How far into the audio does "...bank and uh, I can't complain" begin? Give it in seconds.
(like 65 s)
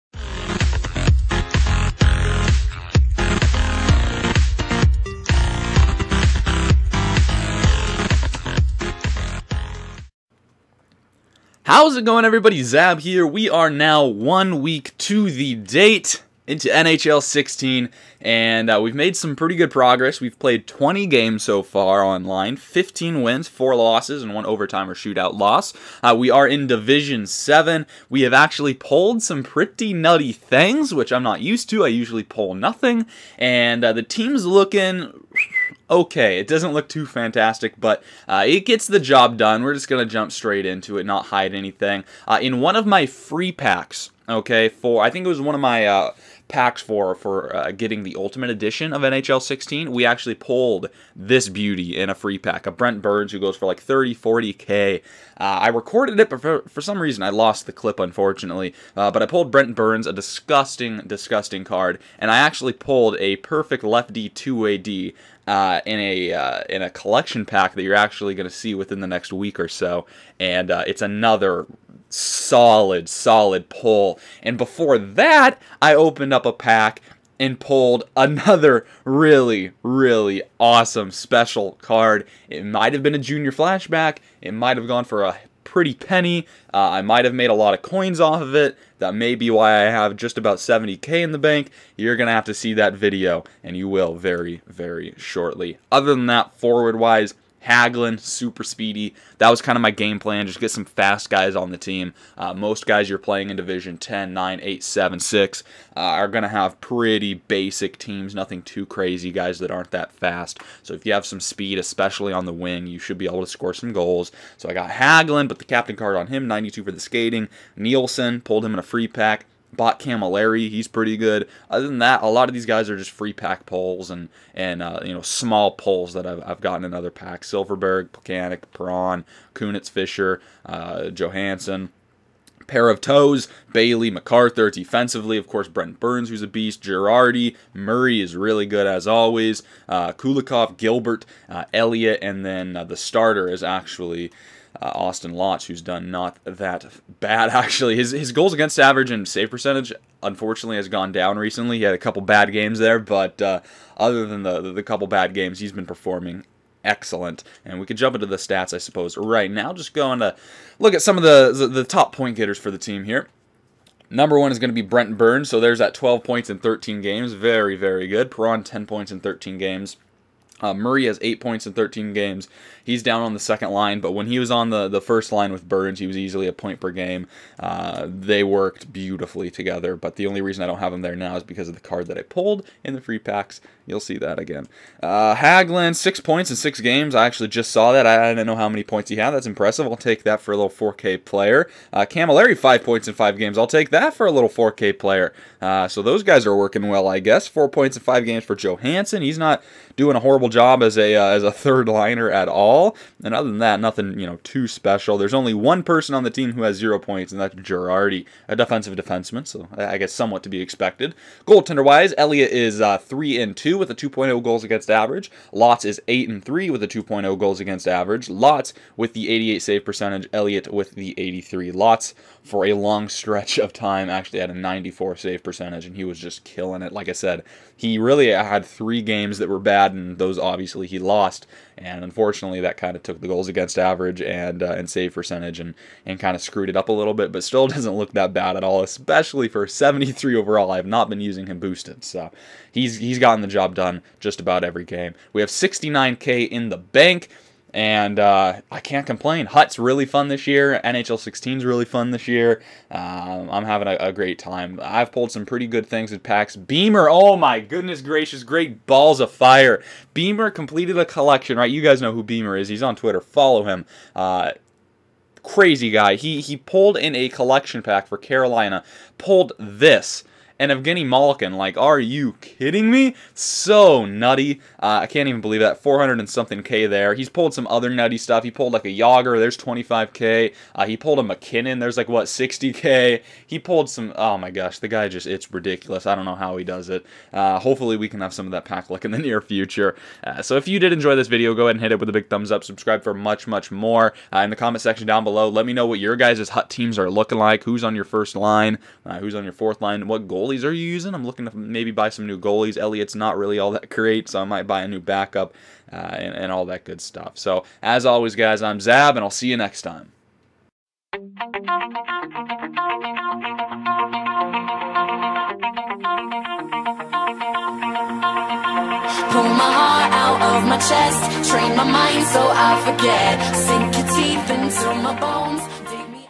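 246 s.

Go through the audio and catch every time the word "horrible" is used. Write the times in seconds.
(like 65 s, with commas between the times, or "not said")
200 s.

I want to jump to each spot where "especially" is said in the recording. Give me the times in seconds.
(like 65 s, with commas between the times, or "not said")
111 s, 238 s.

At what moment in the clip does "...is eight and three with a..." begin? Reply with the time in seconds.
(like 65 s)
215 s.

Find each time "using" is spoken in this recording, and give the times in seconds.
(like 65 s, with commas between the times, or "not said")
241 s, 300 s.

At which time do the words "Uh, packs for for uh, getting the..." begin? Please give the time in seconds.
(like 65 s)
45 s.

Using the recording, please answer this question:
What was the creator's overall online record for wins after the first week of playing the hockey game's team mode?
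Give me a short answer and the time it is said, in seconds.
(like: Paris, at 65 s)
15 wins, at 22 s.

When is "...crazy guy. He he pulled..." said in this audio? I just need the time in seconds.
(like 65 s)
265 s.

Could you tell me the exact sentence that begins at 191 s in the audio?
Uh, Camilleri, five points in five games.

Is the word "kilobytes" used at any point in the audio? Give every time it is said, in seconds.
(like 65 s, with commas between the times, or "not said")
not said.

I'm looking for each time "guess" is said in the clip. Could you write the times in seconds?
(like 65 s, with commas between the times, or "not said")
197 s, 209 s.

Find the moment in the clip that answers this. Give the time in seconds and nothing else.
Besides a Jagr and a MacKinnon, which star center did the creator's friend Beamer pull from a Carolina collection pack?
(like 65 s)
270 s.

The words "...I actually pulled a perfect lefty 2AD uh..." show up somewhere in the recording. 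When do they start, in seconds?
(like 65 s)
62 s.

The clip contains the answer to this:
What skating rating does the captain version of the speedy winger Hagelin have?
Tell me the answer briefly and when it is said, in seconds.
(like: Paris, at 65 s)
92, at 116 s.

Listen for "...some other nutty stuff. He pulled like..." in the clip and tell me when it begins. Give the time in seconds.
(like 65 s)
277 s.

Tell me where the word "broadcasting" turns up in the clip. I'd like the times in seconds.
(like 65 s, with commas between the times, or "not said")
not said.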